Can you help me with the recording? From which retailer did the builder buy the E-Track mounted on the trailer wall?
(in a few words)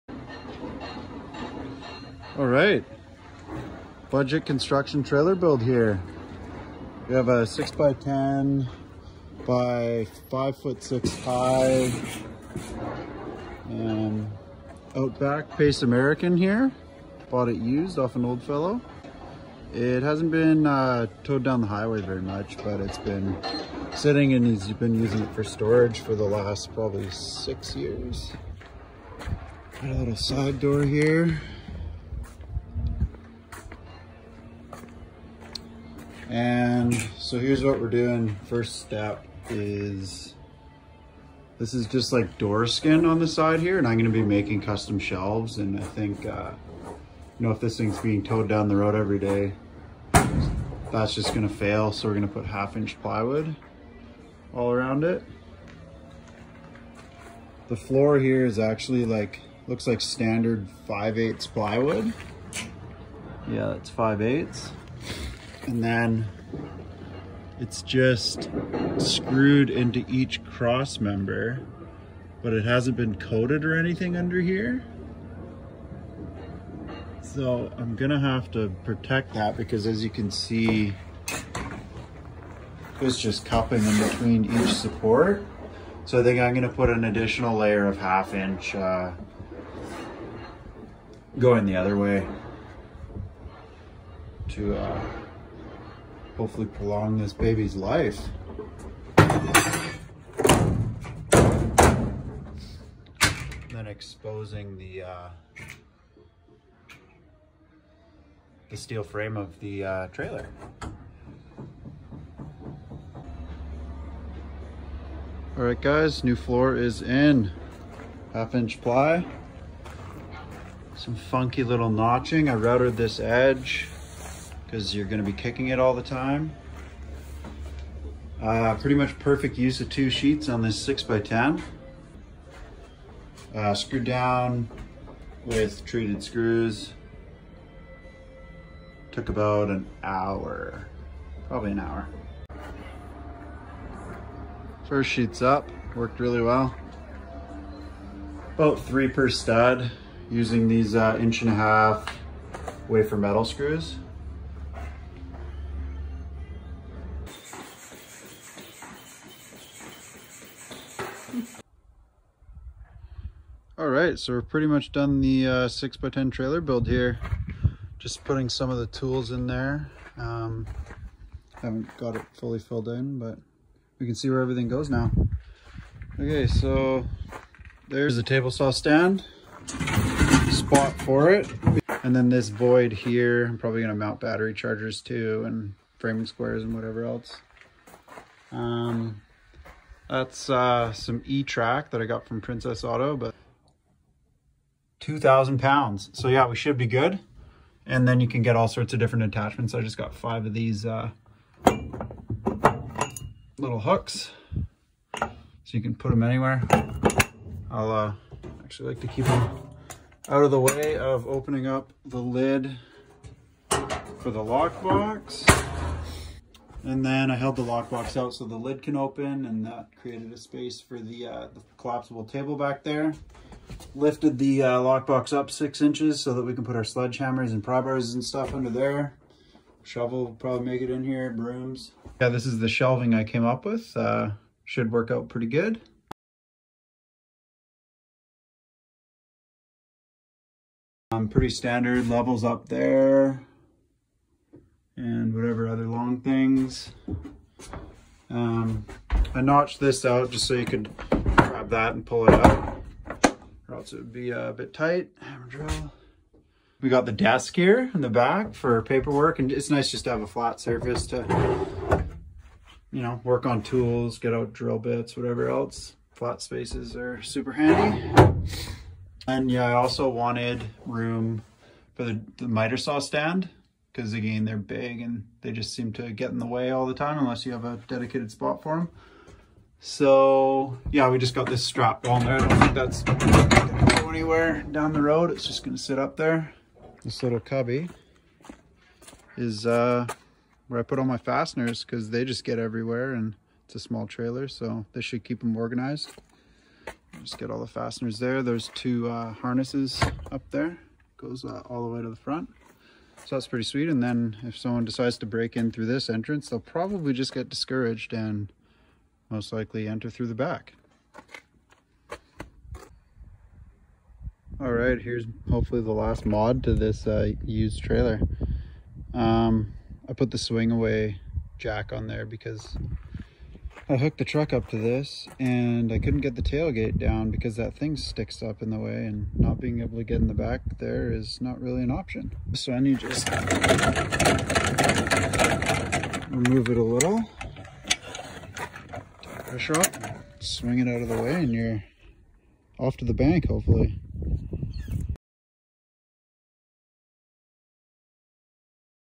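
Princess Auto.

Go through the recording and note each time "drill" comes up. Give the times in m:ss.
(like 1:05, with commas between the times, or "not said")
4:15, 4:24.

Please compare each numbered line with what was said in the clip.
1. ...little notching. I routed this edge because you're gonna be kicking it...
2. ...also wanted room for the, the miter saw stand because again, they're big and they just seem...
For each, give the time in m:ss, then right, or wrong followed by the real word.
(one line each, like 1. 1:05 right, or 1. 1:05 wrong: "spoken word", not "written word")
1. 2:01 right
2. 4:29 right.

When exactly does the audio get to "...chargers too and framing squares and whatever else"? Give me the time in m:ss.
3:04.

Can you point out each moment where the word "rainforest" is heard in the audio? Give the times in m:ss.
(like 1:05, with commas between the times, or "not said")
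not said.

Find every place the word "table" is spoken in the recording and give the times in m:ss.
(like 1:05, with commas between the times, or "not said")
2:58, 3:42.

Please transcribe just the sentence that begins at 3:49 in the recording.
Shovel will probably make it in here, brooms.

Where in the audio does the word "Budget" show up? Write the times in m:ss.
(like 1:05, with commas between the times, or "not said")
0:04.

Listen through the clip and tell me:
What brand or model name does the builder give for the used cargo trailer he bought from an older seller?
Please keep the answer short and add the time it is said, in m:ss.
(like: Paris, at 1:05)
Outback Pace American, at 0:14.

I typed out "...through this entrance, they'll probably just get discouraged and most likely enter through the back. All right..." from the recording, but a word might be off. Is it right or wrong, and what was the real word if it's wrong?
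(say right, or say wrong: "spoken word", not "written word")
right.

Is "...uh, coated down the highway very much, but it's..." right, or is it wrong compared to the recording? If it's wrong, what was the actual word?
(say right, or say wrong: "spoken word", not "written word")
wrong: "towed", not "coated".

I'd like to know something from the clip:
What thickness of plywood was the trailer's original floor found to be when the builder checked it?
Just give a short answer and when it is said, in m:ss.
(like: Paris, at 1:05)
5/8, at 1:03.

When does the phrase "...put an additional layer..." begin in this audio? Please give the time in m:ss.
1:26.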